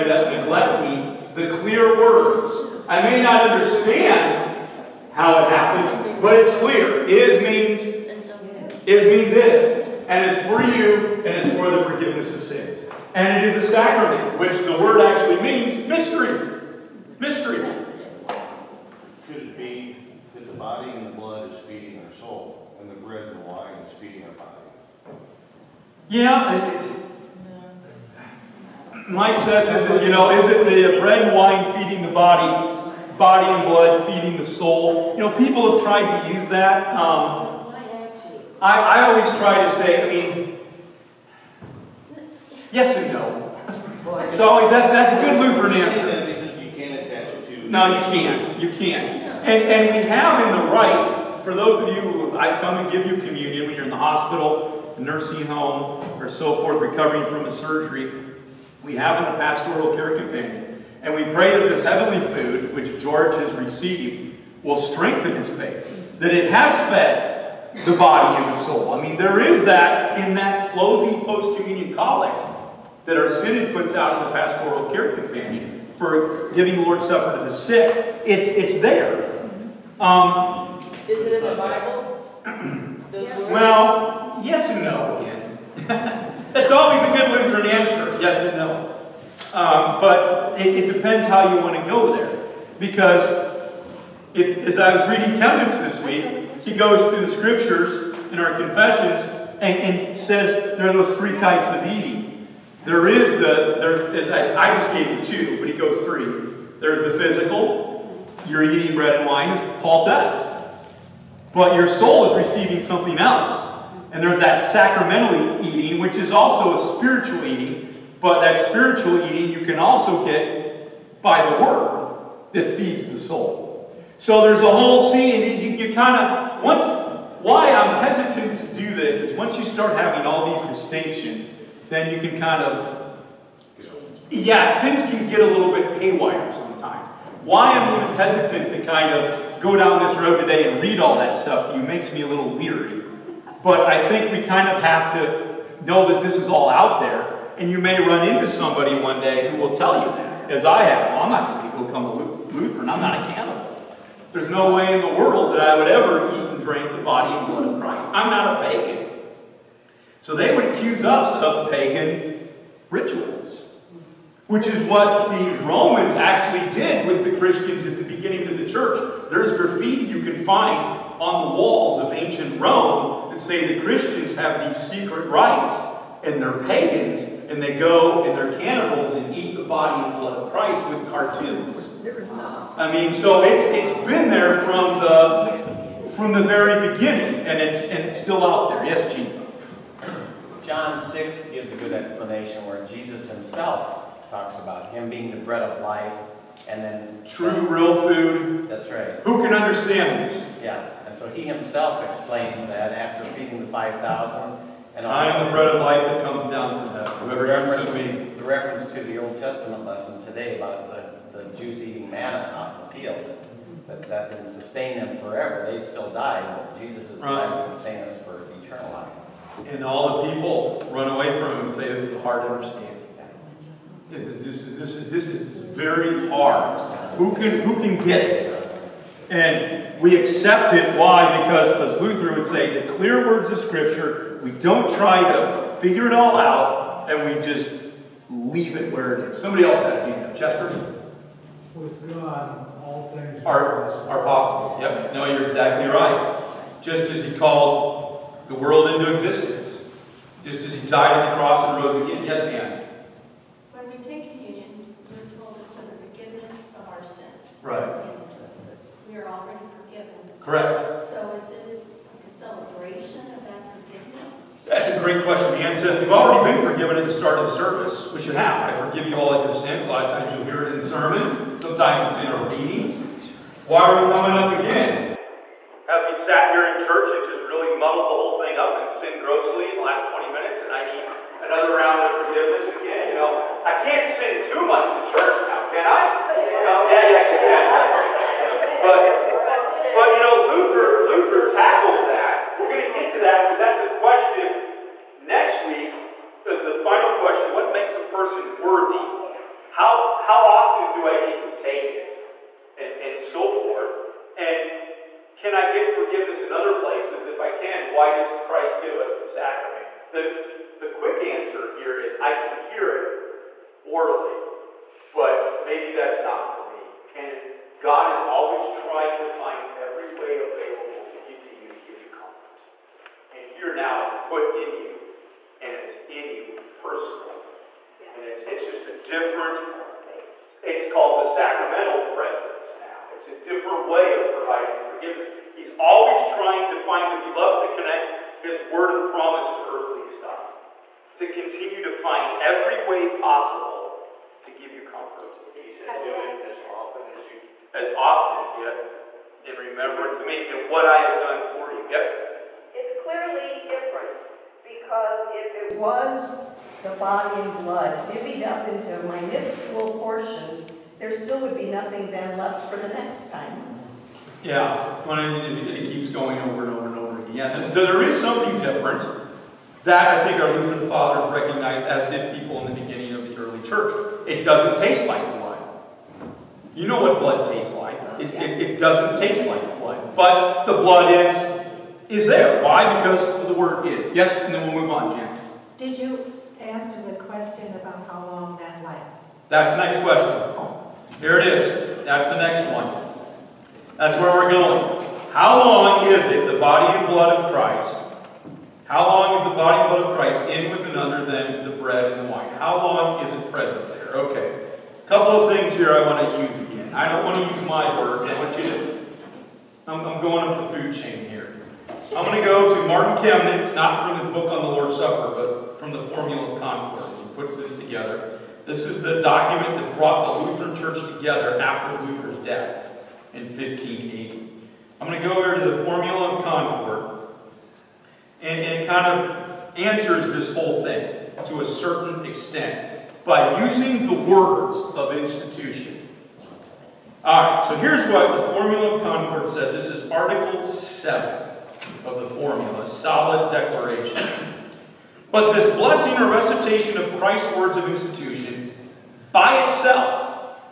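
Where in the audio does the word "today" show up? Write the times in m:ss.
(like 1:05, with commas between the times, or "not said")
2:20, 3:30.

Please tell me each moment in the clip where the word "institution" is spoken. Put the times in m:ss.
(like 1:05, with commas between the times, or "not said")
7:15, 7:27.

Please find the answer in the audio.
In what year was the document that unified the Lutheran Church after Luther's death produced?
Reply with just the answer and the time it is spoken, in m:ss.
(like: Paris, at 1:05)
1580, at 7:03.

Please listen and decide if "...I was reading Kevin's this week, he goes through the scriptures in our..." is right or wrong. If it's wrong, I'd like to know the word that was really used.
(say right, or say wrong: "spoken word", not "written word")
right.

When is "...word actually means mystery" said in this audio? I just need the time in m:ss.
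0:14.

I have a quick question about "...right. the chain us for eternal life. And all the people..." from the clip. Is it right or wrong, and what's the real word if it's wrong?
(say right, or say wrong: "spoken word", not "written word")
wrong: "sustain", not "chain".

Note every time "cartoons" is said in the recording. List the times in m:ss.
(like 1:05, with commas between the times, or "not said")
3:01.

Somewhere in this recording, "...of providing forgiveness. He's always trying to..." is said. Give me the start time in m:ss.
5:34.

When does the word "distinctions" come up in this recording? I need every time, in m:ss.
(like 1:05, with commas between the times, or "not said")
2:10.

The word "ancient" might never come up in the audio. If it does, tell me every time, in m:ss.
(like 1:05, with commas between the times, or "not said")
2:52.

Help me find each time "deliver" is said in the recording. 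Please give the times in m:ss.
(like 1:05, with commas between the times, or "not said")
not said.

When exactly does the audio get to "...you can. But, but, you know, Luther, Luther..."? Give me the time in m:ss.
4:48.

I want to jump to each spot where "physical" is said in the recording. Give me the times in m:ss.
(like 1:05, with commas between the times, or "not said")
1:47.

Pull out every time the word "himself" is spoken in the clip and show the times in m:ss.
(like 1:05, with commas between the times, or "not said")
3:13, 3:21.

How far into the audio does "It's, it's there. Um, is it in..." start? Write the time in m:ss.
1:18.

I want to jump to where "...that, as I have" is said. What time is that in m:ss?
2:30.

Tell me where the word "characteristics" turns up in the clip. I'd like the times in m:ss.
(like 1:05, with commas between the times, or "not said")
not said.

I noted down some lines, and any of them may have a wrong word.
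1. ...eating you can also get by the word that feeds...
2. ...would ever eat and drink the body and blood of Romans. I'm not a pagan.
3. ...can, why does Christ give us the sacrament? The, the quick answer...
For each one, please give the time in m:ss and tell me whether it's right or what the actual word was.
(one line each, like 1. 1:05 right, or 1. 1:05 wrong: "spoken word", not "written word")
1. 1:59 right
2. 2:35 wrong: "Christ", not "Romans"
3. 5:07 right.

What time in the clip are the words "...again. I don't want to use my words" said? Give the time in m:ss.
6:46.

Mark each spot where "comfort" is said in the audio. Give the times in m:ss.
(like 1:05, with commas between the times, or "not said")
5:22, 5:44.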